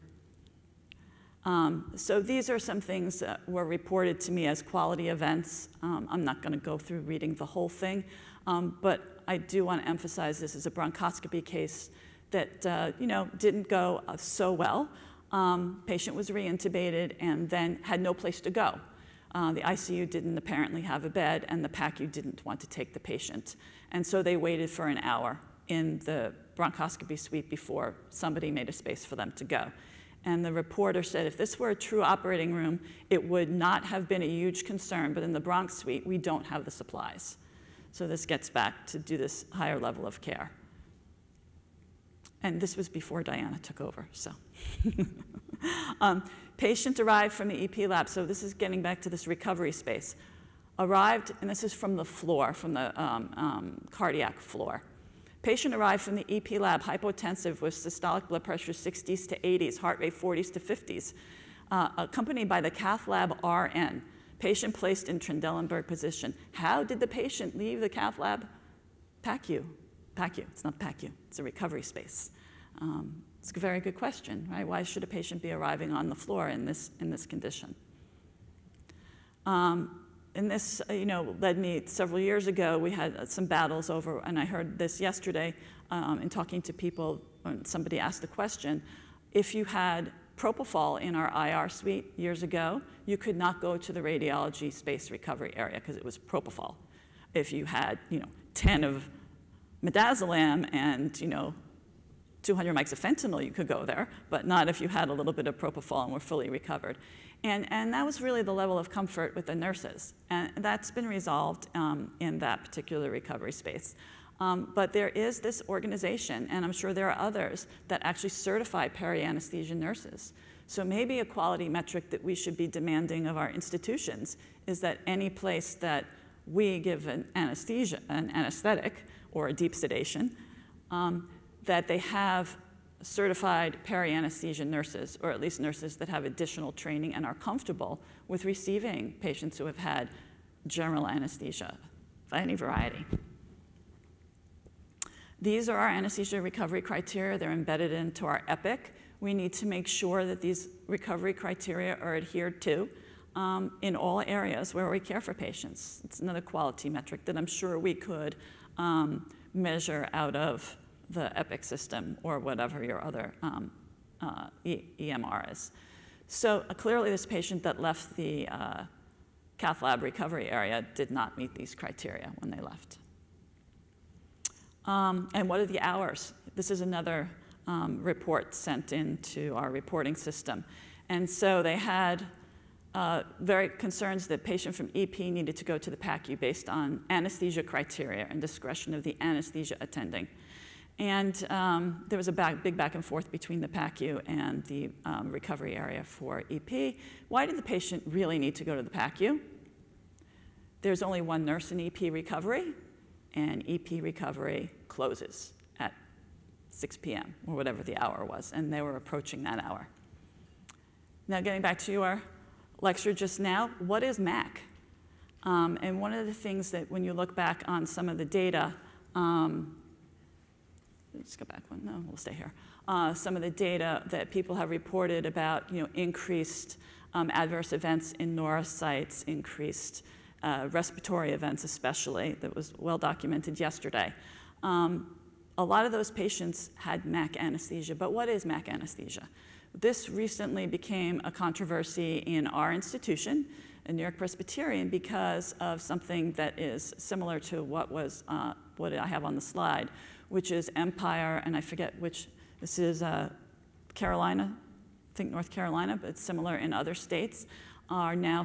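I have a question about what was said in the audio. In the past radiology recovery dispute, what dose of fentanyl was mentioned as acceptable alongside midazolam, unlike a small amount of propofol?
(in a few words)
200 mics.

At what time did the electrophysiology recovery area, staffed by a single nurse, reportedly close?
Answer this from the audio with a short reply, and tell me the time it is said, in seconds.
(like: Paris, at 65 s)
6 p.m., at 206 s.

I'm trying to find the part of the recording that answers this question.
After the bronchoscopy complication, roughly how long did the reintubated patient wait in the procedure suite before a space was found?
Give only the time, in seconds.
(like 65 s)
24 s.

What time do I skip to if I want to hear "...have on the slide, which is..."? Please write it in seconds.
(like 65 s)
249 s.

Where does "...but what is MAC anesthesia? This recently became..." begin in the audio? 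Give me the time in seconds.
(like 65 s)
237 s.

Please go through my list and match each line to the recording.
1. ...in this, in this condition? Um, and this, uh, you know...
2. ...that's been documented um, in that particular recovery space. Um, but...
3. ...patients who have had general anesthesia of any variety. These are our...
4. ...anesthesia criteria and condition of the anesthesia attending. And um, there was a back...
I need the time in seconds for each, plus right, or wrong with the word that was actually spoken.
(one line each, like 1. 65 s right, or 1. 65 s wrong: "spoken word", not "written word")
1. 76 s right
2. 110 s wrong: "resolved", not "documented"
3. 139 s right
4. 187 s wrong: "discretion", not "condition".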